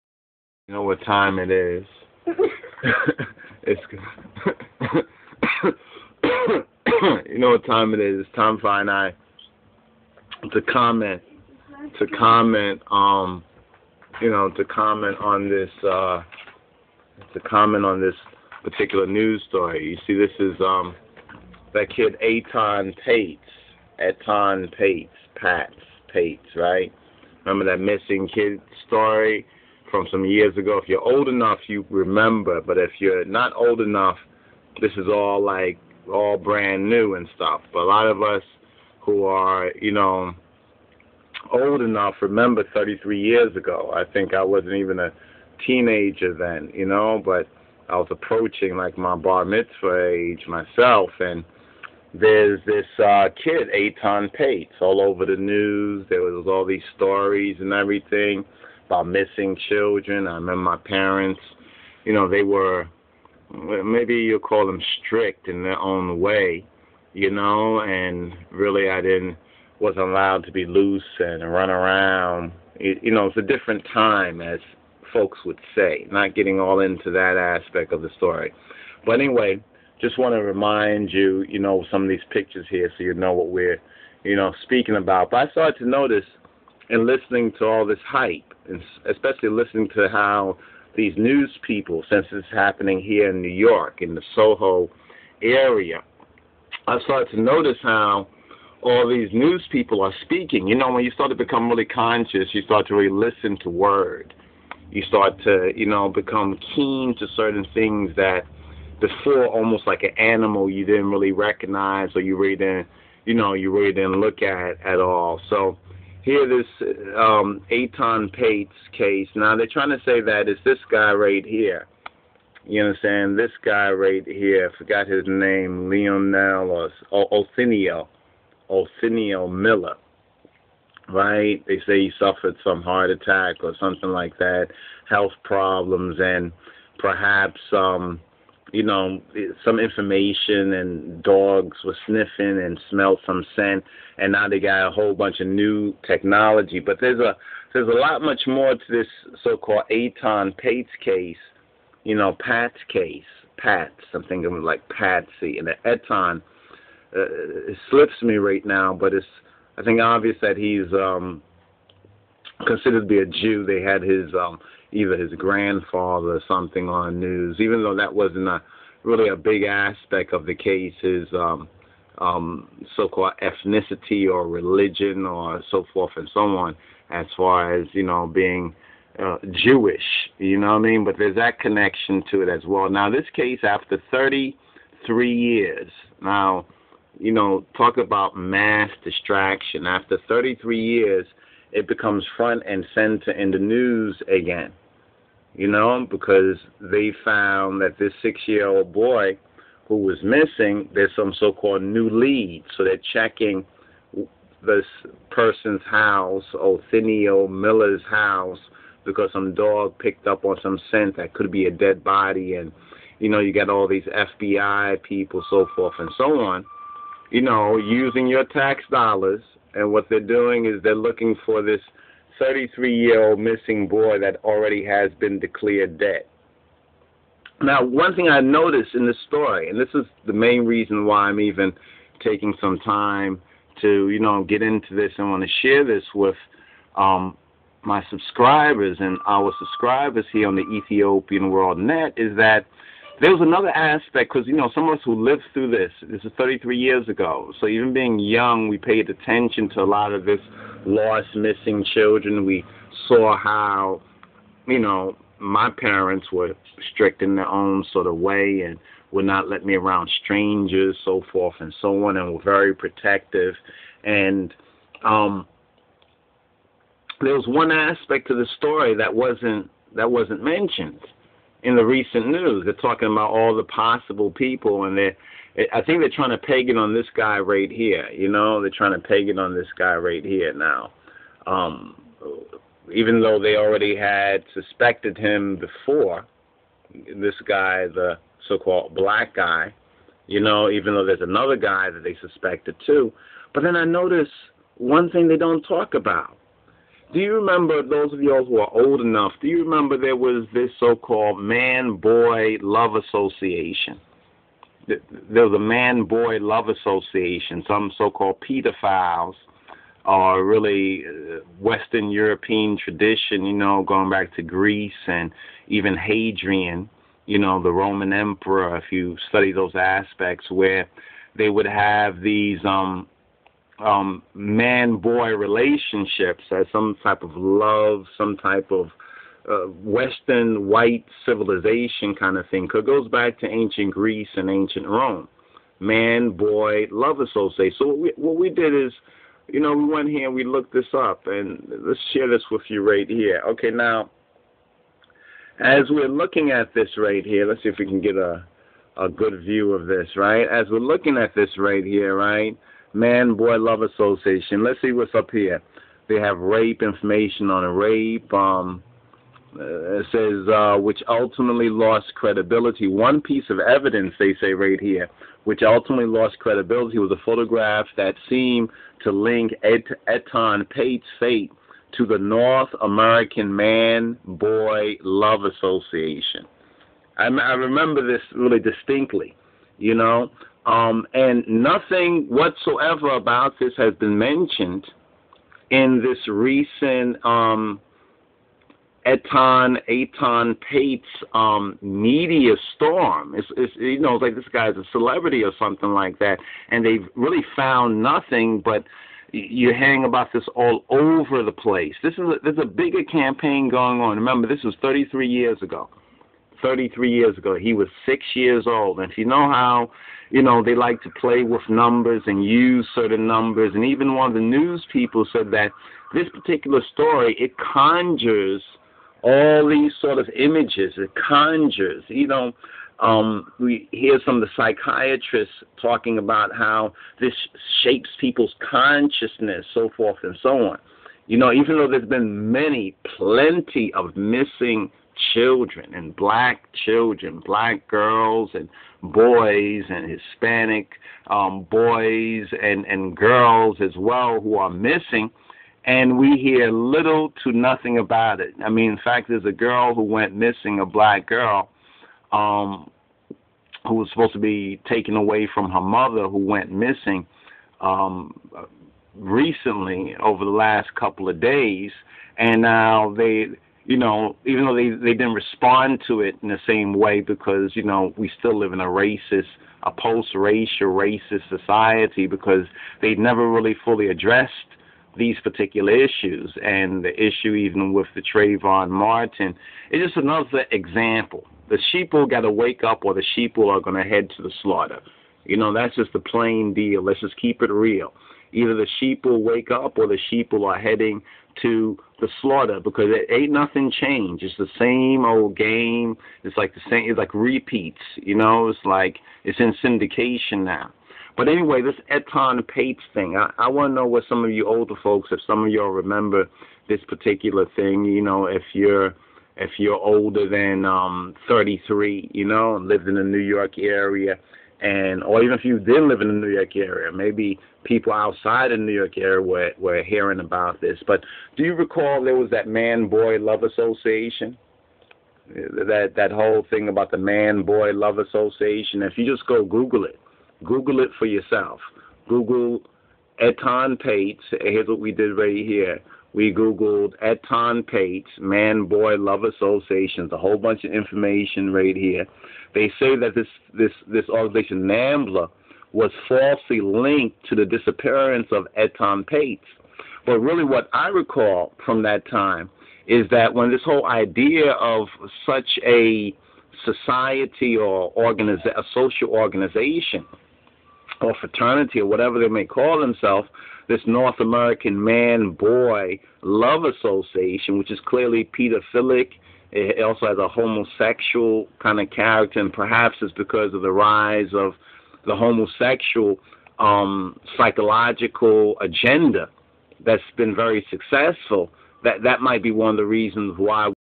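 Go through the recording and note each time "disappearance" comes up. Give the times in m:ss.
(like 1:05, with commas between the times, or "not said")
9:07.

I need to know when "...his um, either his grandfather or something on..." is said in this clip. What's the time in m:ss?
2:44.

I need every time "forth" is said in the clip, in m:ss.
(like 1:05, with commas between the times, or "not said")
2:55, 3:35, 4:21, 7:09.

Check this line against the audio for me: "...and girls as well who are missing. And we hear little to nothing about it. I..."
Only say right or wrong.
right.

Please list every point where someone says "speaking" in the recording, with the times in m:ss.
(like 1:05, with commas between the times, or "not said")
1:24, 1:40.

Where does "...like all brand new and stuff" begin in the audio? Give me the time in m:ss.
0:35.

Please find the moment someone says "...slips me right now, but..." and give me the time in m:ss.
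2:37.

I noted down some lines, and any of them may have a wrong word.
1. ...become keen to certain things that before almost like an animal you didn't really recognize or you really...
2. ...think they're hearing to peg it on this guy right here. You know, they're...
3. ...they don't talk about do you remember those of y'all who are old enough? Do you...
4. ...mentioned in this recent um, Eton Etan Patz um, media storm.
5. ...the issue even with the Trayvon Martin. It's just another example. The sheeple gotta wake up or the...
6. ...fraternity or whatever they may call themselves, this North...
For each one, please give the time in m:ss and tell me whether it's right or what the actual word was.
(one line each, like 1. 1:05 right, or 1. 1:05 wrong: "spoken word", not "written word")
1. 1:46 right
2. 4:35 wrong: "trying", not "hearing"
3. 4:55 right
4. 6:24 right
5. 7:57 right
6. 9:21 right.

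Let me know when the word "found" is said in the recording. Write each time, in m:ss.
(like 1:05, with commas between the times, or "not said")
3:17, 6:37.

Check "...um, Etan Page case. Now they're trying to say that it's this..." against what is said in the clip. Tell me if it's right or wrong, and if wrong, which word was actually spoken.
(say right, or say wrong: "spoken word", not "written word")
wrong: "Patz", not "Page".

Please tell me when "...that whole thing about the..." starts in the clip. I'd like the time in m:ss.
8:46.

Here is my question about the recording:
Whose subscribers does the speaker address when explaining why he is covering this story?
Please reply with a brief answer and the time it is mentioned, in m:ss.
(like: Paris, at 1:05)
Ethiopian World Net, at 4:00.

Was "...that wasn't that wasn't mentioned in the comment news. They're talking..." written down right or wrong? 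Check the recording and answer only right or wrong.
wrong.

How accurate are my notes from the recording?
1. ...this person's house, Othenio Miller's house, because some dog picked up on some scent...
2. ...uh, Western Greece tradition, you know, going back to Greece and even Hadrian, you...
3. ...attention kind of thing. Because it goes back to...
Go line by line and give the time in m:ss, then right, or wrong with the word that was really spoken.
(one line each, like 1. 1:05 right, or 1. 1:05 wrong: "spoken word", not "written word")
1. 3:24 right
2. 5:11 wrong: "European", not "Greece"
3. 5:31 wrong: "civilization", not "attention".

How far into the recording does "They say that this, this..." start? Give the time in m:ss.
9:02.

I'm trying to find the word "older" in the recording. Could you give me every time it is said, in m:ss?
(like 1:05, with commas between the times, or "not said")
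8:24, 8:29.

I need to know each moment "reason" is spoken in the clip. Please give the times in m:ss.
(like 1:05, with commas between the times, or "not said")
3:50, 9:43.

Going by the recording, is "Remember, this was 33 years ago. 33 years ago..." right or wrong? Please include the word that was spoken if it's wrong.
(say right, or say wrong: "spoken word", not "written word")
right.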